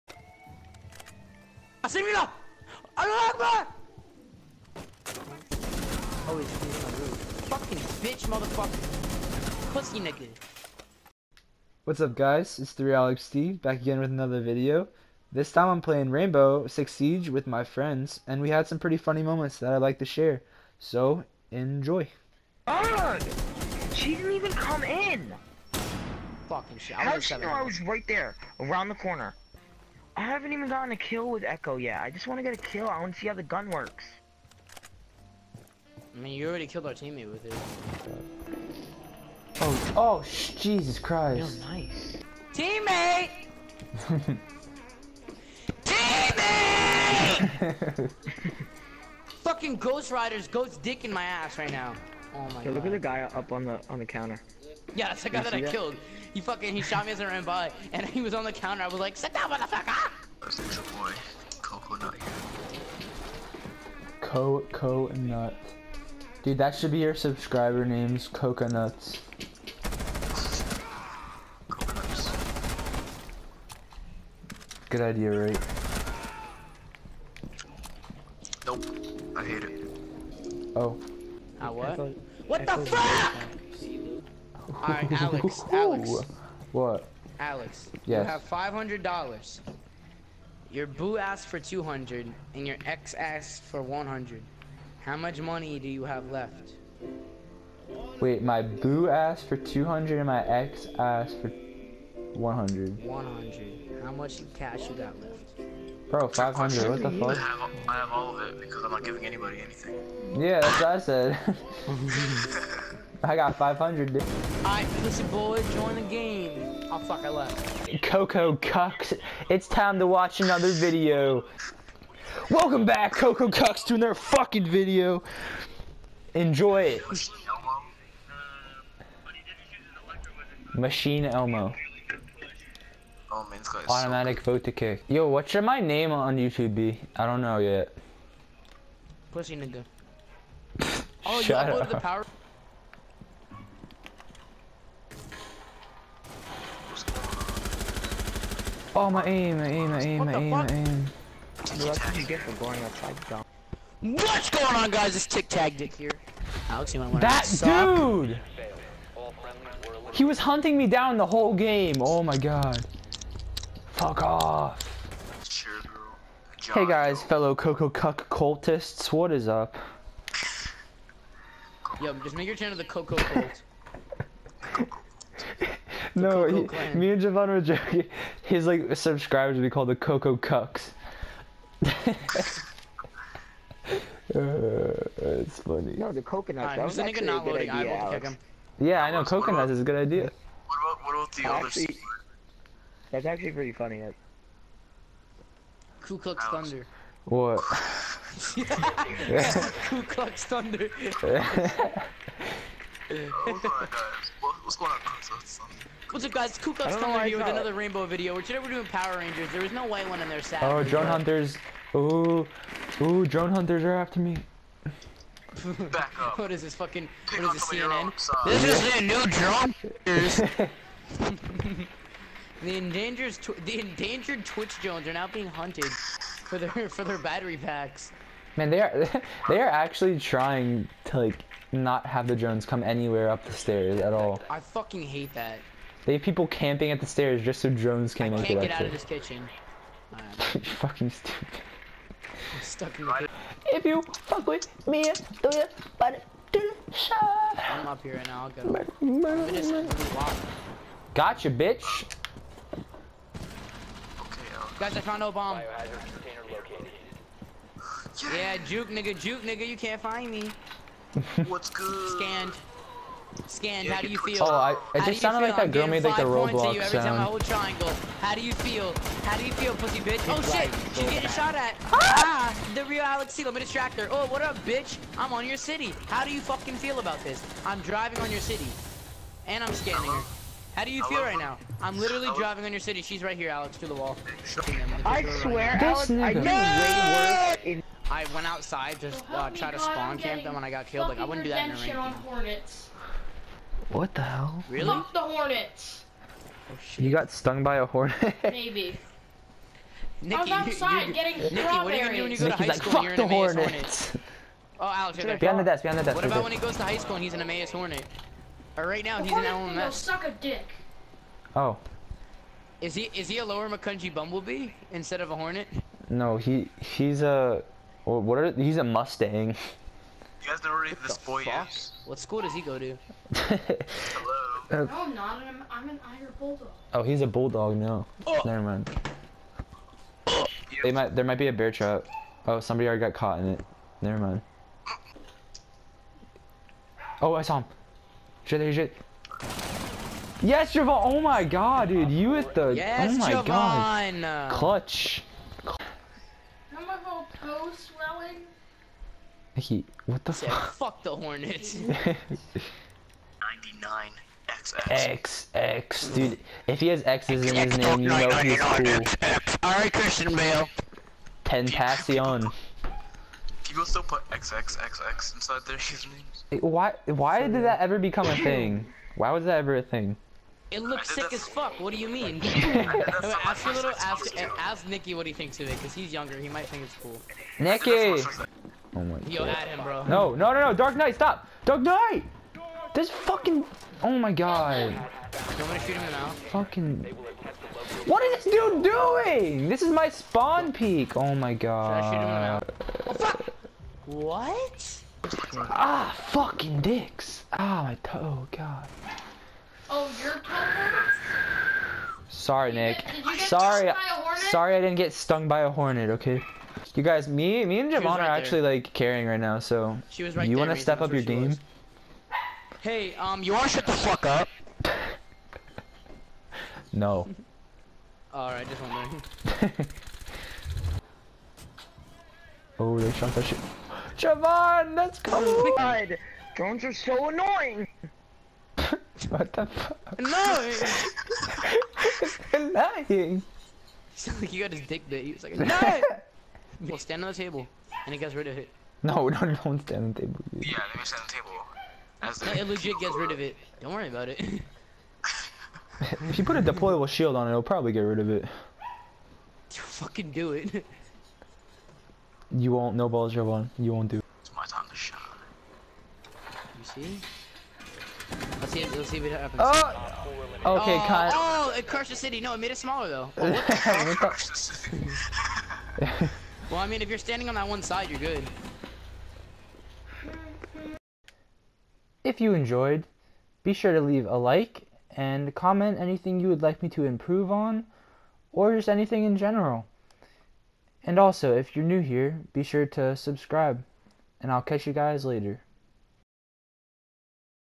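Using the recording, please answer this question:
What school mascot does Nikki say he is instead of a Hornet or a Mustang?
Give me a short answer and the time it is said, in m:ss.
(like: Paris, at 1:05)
Irish bulldog, at 5:26.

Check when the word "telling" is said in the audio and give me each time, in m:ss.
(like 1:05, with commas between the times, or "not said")
not said.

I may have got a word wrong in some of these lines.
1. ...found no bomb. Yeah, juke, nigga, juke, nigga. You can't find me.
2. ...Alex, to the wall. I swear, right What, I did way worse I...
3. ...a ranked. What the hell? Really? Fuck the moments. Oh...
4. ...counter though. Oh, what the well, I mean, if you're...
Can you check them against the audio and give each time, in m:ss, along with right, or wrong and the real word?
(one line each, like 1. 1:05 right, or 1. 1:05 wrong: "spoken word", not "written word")
1. 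4:15 right
2. 4:43 wrong: "Alex", not "What"
3. 4:51 wrong: "hornets", not "moments"
4. 7:42 wrong: "smaller", not "counter".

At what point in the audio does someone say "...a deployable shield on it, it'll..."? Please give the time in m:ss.
7:26.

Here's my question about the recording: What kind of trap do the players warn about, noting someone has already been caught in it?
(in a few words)
Bear trap.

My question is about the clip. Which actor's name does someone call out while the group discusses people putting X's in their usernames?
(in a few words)
Christian Bale.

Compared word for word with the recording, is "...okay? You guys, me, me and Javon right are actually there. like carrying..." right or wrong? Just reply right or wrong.
right.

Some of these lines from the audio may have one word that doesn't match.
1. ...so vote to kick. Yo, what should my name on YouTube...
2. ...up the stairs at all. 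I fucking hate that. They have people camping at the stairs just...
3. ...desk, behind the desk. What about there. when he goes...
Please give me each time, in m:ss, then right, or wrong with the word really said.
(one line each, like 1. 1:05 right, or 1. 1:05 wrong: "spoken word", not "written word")
1. 2:14 right
2. 3:53 right
3. 5:05 right.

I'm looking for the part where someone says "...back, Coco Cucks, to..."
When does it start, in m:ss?
2:02.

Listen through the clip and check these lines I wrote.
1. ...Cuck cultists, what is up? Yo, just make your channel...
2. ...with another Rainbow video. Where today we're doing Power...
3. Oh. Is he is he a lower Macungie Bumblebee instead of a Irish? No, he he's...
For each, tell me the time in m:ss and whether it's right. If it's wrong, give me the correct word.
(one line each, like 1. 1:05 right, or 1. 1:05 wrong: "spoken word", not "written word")
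1. 2:47 right
2. 3:27 right
3. 5:11 wrong: "Hornet", not "Irish".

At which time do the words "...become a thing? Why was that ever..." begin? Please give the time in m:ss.
6:07.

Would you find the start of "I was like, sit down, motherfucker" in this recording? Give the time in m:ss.
0:58.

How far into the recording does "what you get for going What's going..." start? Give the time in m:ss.
2:31.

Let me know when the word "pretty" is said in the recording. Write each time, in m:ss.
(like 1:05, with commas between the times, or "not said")
0:18, 3:13.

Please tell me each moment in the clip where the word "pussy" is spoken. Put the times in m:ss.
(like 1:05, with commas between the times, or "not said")
0:09, 2:19, 4:29.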